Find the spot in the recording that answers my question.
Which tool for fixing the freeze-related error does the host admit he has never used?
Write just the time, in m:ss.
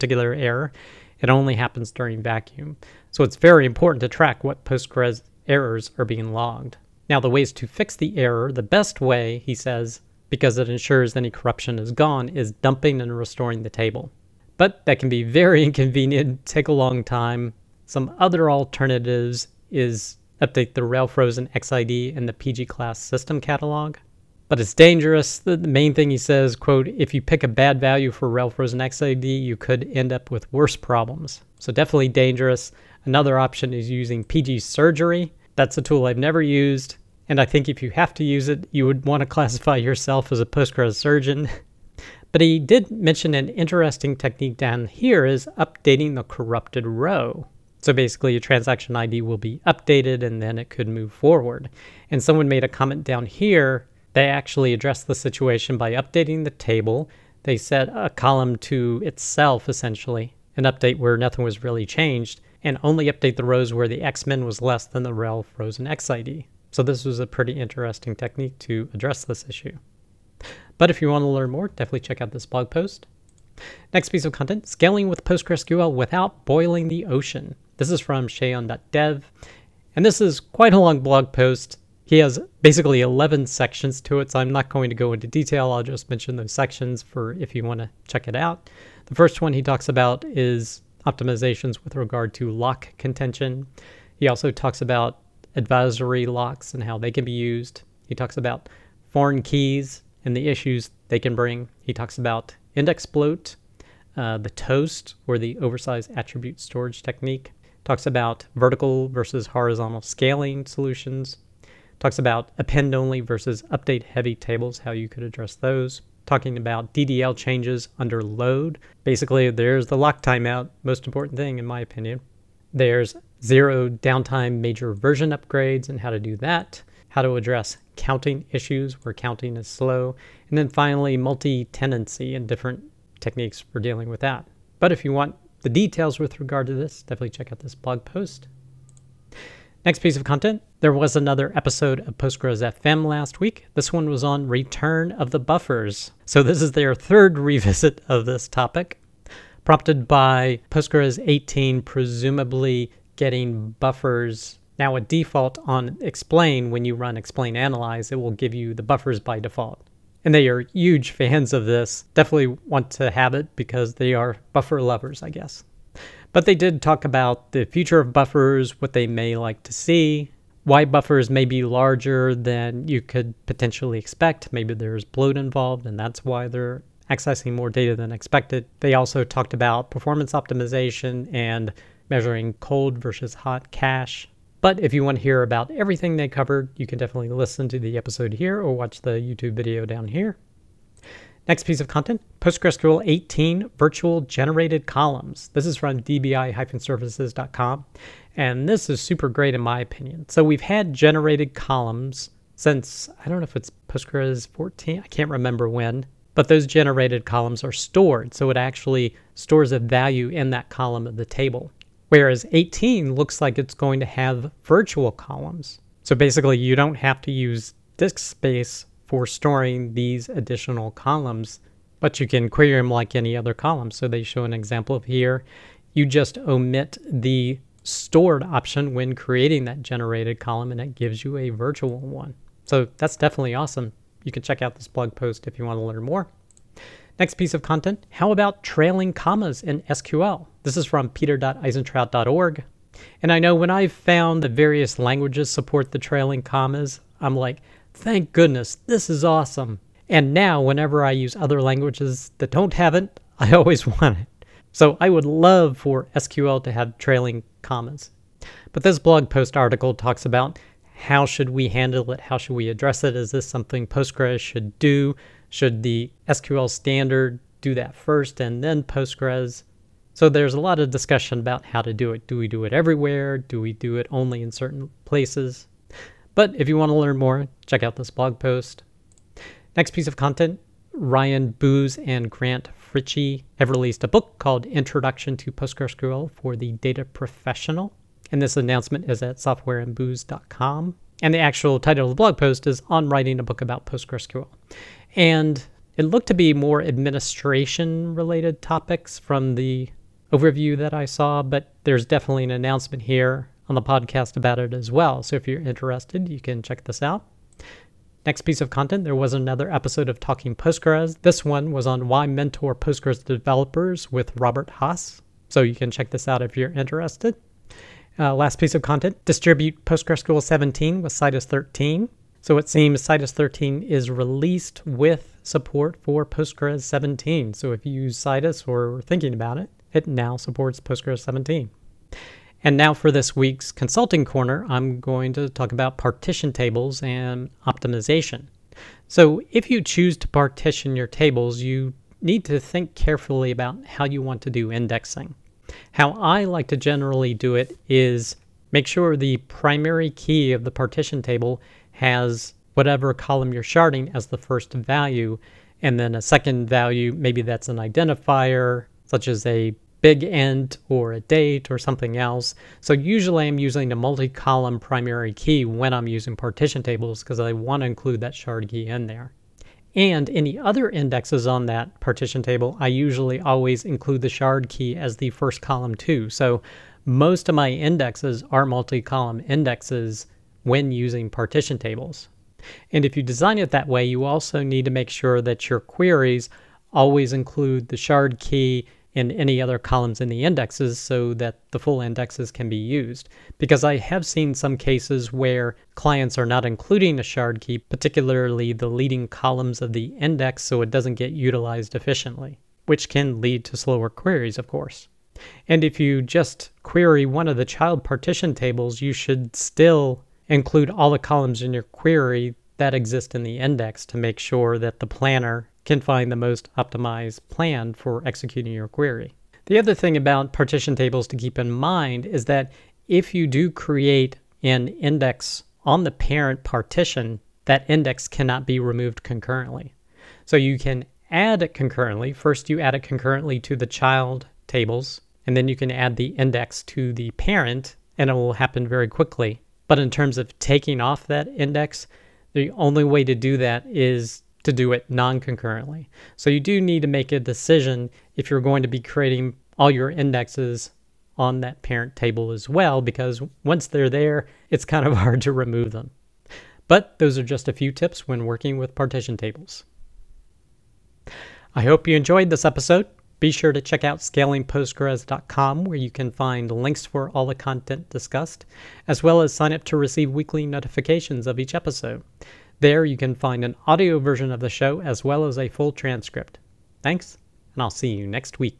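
0:34.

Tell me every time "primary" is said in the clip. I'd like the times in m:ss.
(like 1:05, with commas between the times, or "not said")
5:49, 6:04.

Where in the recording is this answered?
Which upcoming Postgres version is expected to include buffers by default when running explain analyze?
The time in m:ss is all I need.
2:30.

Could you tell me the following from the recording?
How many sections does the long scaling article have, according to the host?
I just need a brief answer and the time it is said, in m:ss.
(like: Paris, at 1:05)
11, at 1:23.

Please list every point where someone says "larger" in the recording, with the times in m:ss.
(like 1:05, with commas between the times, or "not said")
2:51.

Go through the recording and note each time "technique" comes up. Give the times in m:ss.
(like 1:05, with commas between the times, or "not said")
0:44, 1:08, 1:47, 2:13.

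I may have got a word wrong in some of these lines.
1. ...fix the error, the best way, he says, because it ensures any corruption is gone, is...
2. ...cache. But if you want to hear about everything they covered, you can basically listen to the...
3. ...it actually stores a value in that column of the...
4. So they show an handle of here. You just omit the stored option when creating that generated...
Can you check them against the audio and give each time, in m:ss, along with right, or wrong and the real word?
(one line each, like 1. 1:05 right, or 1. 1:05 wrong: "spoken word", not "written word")
1. 0:07 right
2. 3:03 wrong: "definitely", not "basically"
3. 3:28 right
4. 3:43 wrong: "example", not "handle".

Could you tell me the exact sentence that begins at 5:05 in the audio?
So if you're interested, you can check this out.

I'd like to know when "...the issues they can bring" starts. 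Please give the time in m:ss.
1:40.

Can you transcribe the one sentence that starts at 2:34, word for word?
Now a default on explain, when you run explain analyze, it will give you the buffers by default.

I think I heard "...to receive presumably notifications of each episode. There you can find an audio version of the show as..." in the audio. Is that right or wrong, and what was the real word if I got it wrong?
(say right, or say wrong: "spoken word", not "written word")
wrong: "weekly", not "presumably".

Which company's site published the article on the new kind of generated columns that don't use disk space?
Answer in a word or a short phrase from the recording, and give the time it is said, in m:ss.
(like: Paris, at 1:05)
dbi-services.com, at 3:15.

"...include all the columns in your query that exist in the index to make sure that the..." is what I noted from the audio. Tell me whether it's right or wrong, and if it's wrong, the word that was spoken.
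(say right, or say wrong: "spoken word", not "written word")
right.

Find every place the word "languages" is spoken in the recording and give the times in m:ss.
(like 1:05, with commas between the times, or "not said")
4:04, 4:11.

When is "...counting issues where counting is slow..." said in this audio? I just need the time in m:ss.
2:07.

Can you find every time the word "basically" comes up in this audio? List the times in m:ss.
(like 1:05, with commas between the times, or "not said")
0:47, 1:22, 1:59, 3:36.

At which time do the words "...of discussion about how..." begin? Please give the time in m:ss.
4:30.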